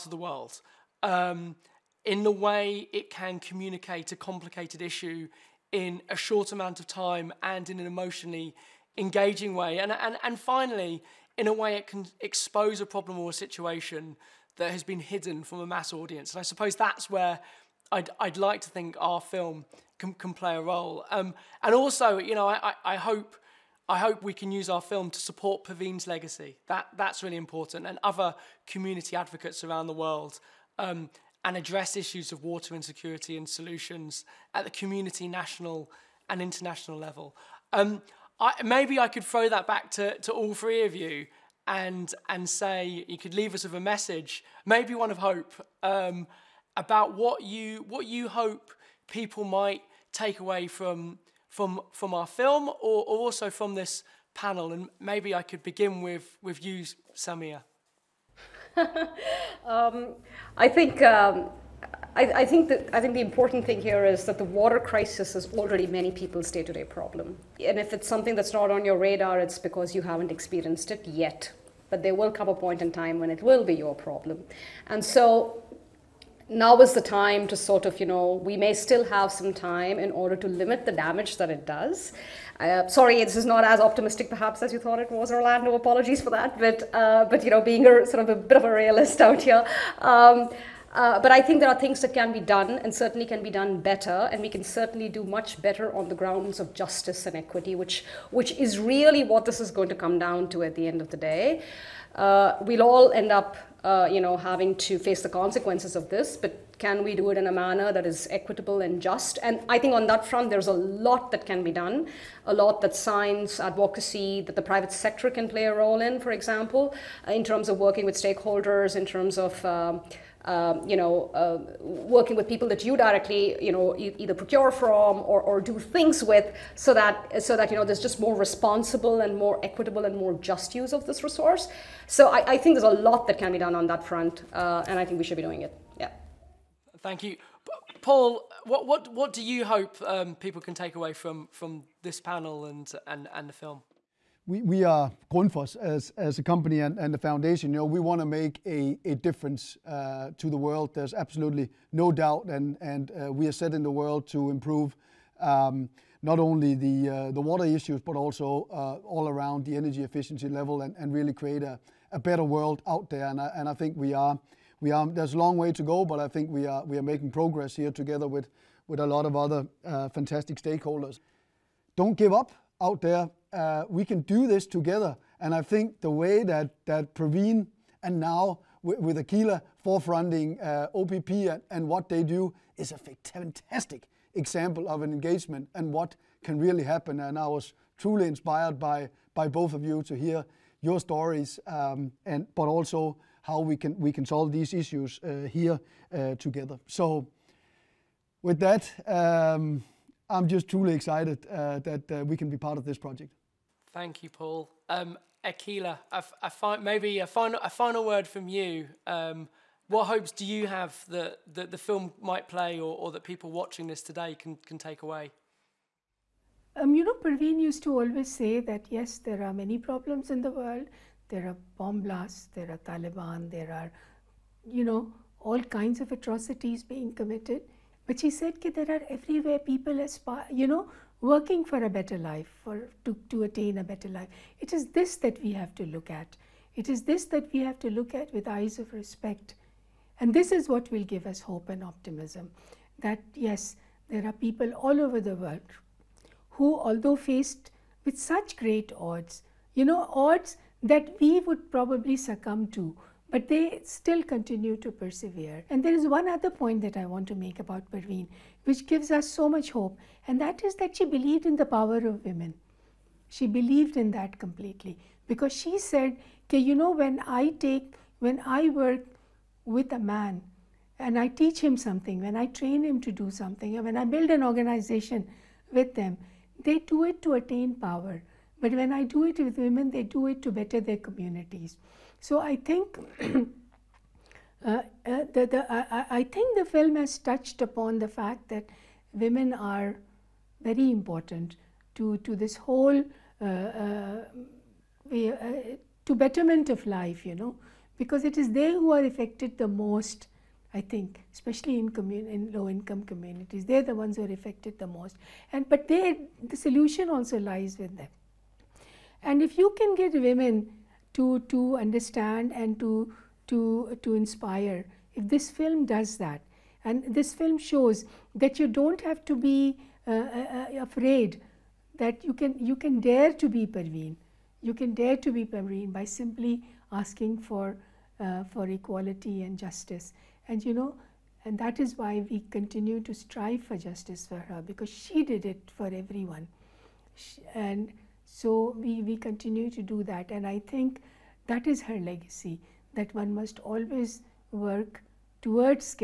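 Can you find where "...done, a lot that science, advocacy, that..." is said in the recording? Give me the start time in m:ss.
1:51.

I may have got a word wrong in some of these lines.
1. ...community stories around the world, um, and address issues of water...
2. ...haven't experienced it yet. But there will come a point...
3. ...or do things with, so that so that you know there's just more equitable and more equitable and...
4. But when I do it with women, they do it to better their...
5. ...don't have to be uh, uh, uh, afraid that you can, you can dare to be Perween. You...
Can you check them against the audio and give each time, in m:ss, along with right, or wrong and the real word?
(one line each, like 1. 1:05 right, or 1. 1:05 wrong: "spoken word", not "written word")
1. 0:28 wrong: "advocates", not "stories"
2. 1:10 right
3. 2:05 wrong: "responsible", not "equitable"
4. 4:38 right
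5. 5:18 right.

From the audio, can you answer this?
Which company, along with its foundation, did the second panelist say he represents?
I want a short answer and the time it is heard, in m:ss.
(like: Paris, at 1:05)
Grundfos, at 2:25.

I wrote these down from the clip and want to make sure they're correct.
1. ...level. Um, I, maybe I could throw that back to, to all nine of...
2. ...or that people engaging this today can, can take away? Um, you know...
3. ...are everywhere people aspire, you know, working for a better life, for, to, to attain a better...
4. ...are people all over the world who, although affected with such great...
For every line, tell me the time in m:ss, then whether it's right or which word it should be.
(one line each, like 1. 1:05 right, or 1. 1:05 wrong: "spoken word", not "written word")
1. 0:36 wrong: "three", not "nine"
2. 3:32 wrong: "watching", not "engaging"
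3. 3:48 right
4. 4:04 wrong: "faced", not "affected".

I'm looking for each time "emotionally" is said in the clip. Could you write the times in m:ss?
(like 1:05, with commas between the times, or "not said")
0:07.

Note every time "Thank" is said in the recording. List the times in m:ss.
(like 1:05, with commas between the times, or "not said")
2:17, 3:23.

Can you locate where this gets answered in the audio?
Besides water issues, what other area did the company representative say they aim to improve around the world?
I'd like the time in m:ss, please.
2:39.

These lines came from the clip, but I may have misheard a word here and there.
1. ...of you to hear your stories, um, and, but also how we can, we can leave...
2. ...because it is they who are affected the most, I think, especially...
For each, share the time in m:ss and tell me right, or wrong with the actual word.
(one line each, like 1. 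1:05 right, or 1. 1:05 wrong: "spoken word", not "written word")
1. 3:09 wrong: "solve", not "leave"
2. 4:57 right.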